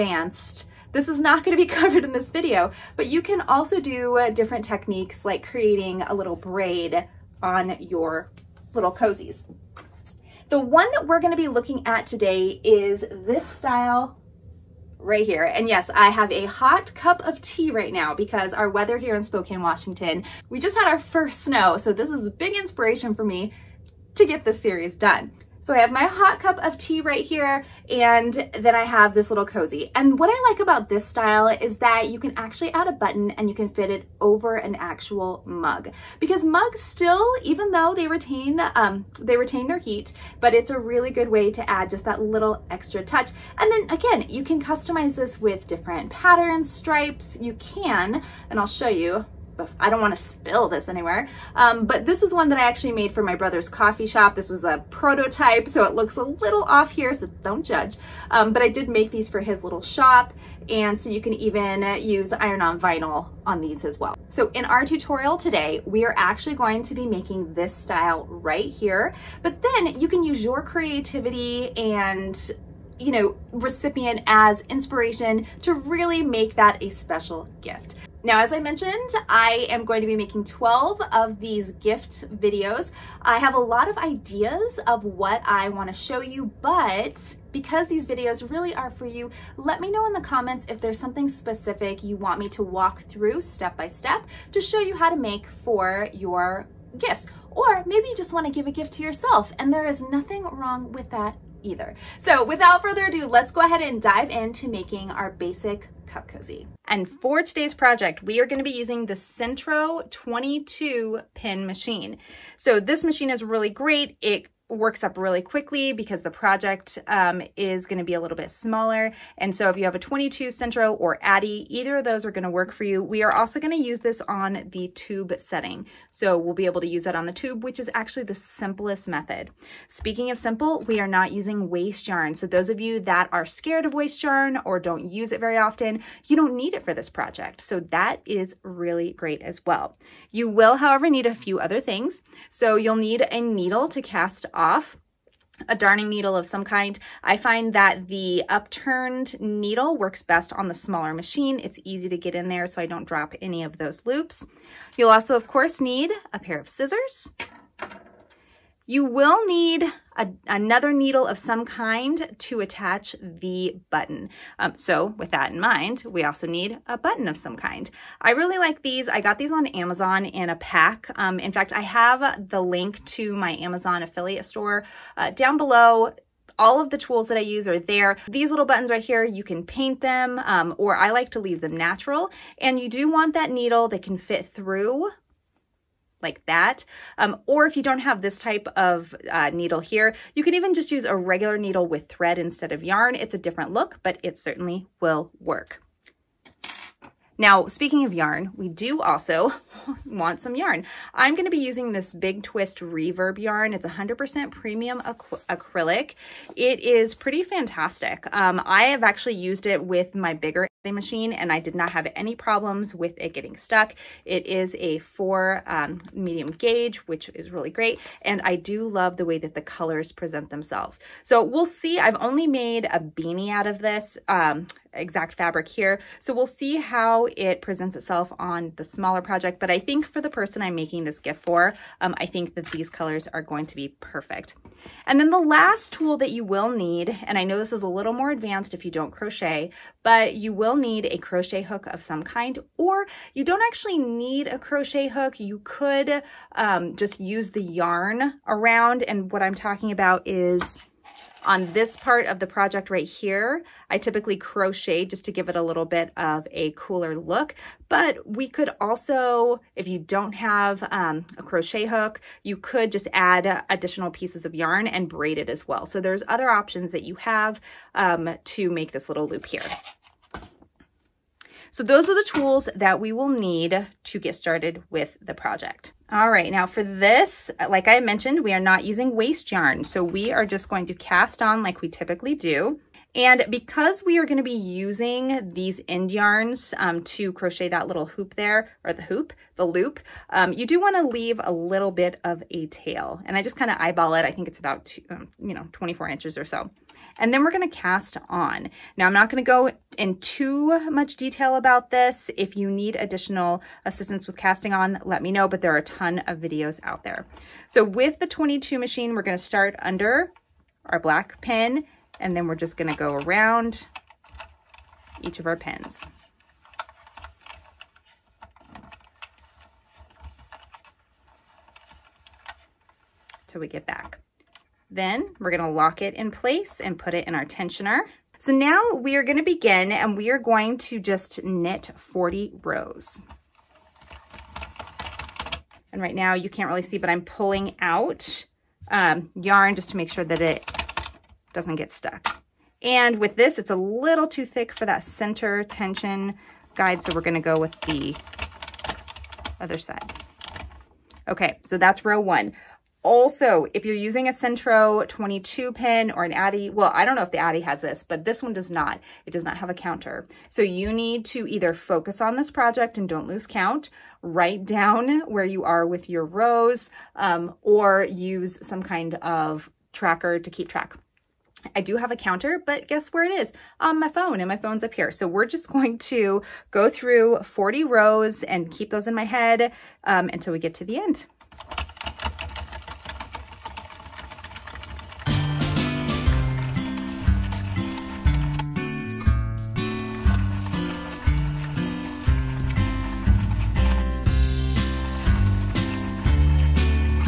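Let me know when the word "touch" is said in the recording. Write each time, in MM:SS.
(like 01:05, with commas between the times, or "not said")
00:43.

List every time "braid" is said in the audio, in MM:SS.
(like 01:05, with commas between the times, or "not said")
00:06, 04:25.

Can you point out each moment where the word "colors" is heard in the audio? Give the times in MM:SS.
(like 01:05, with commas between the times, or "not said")
03:39, 03:52.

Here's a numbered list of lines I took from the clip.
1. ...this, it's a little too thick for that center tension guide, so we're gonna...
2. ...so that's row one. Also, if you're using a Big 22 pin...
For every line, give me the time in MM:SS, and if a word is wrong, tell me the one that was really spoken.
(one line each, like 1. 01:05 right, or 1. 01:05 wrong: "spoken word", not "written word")
1. 05:43 right
2. 05:51 wrong: "Sentro", not "Big".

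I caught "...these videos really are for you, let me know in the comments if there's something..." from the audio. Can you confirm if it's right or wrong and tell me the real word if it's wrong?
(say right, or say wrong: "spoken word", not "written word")
right.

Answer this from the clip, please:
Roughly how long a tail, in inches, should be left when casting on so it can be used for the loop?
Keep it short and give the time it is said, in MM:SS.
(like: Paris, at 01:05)
24 inches, at 04:55.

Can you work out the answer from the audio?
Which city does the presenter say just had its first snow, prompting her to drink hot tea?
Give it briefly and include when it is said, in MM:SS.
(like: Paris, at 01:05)
Spokane, at 00:19.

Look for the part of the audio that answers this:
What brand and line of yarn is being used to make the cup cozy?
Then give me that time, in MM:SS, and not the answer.
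03:22.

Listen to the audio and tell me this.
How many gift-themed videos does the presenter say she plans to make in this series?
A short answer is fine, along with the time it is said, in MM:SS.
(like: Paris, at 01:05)
12, at 01:20.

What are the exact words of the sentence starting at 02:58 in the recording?
These little buttons right here, you can paint them um, or I like to leave them natural.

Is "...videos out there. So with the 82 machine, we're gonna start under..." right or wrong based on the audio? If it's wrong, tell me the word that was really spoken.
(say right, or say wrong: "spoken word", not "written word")
wrong: "22", not "82".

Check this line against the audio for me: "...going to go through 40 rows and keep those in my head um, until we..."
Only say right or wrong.
right.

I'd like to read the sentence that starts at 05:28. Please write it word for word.
So now we are gonna begin and we are going to just knit 40 rows.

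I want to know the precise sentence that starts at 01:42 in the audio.
So without further ado, let's go ahead and dive into making our basic cup cozy.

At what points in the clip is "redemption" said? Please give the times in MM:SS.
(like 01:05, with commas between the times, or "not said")
not said.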